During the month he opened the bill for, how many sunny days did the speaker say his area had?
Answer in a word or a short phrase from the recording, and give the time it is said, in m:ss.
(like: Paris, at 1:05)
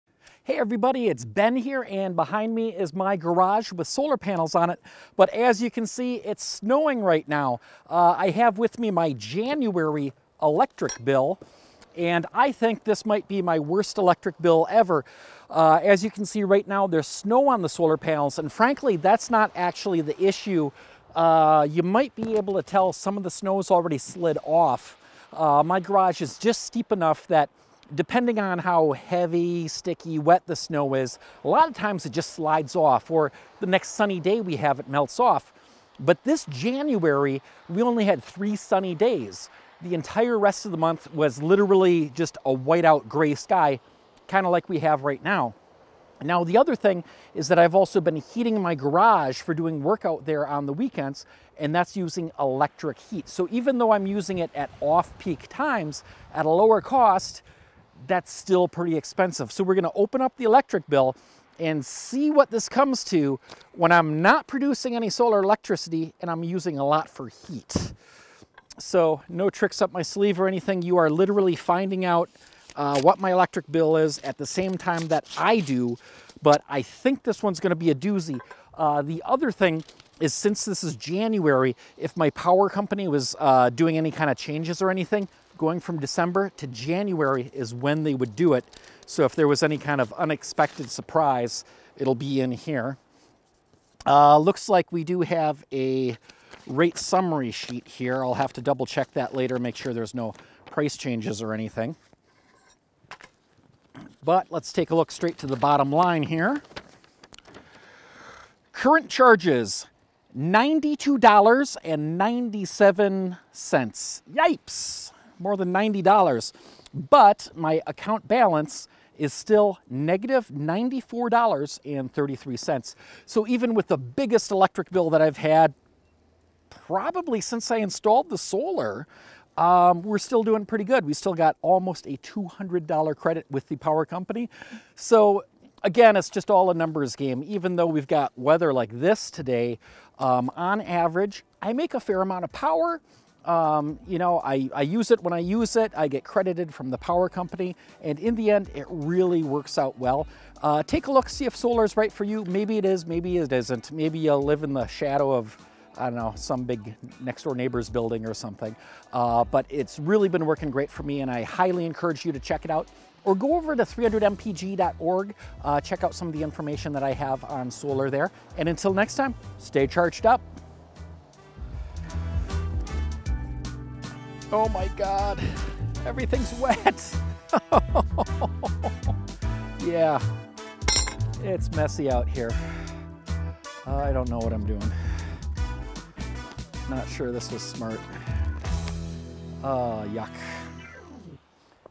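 3, at 0:38.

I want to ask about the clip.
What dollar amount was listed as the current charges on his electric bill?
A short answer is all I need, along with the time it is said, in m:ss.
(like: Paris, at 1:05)
$92.97, at 1:50.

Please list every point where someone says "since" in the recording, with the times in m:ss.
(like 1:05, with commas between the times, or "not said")
1:20, 2:07.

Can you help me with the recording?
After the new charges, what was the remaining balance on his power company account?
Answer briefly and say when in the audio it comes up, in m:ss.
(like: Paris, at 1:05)
-$94.33, at 1:59.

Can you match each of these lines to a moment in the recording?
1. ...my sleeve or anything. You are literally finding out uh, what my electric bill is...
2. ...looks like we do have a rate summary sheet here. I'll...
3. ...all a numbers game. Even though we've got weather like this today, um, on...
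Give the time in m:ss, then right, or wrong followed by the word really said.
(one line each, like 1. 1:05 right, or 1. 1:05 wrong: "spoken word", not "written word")
1. 1:09 right
2. 1:34 right
3. 2:16 right.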